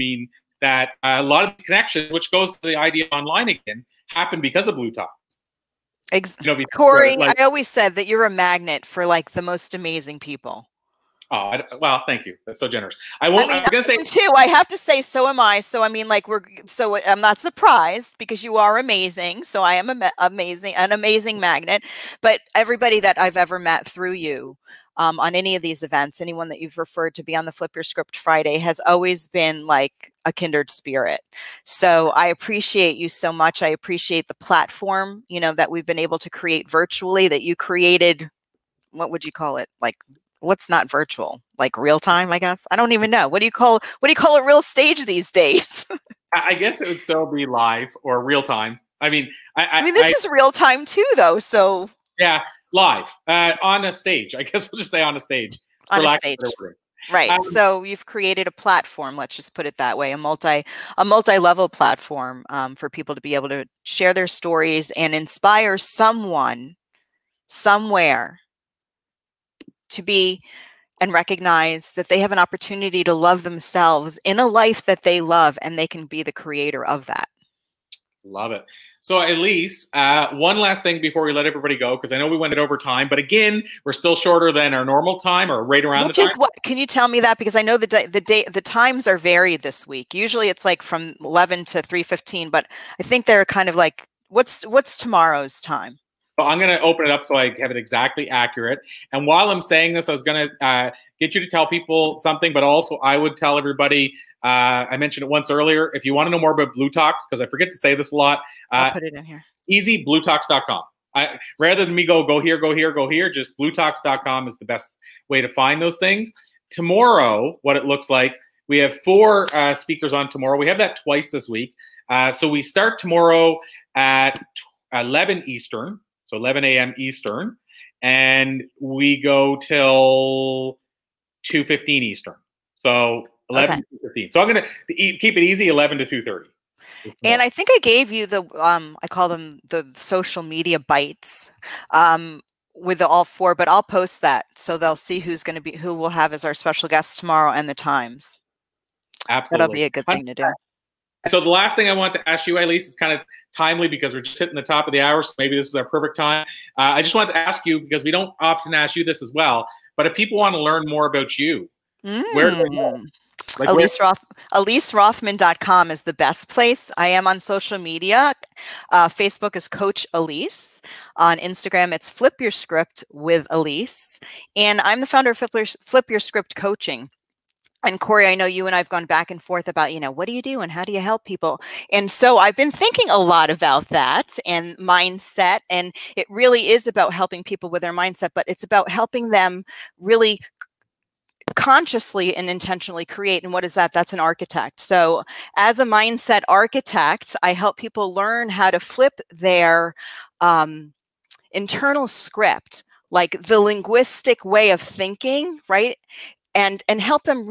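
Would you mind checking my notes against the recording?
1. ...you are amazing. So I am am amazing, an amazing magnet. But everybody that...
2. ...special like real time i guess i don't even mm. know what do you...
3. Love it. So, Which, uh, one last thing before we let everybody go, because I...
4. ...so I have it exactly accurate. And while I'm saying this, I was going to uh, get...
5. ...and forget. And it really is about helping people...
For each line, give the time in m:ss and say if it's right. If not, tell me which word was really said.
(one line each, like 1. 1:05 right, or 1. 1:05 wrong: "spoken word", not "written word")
1. 0:18 right
2. 0:40 wrong: "virtual", not "special"
3. 1:18 wrong: "Elise", not "Which"
4. 1:37 right
5. 3:04 wrong: "mindset", not "forget".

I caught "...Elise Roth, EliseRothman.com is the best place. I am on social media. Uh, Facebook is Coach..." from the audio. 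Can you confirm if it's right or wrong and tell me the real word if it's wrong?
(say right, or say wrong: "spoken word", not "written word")
right.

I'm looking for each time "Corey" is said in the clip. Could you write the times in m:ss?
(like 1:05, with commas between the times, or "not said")
0:06, 2:58.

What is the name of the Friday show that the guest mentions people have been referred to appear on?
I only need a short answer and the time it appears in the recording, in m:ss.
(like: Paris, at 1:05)
Flip Your Script Friday, at 0:27.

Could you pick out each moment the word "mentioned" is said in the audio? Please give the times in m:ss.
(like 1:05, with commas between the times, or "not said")
1:44.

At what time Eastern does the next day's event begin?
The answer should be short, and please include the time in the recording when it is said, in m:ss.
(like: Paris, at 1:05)
11 a.m., at 2:06.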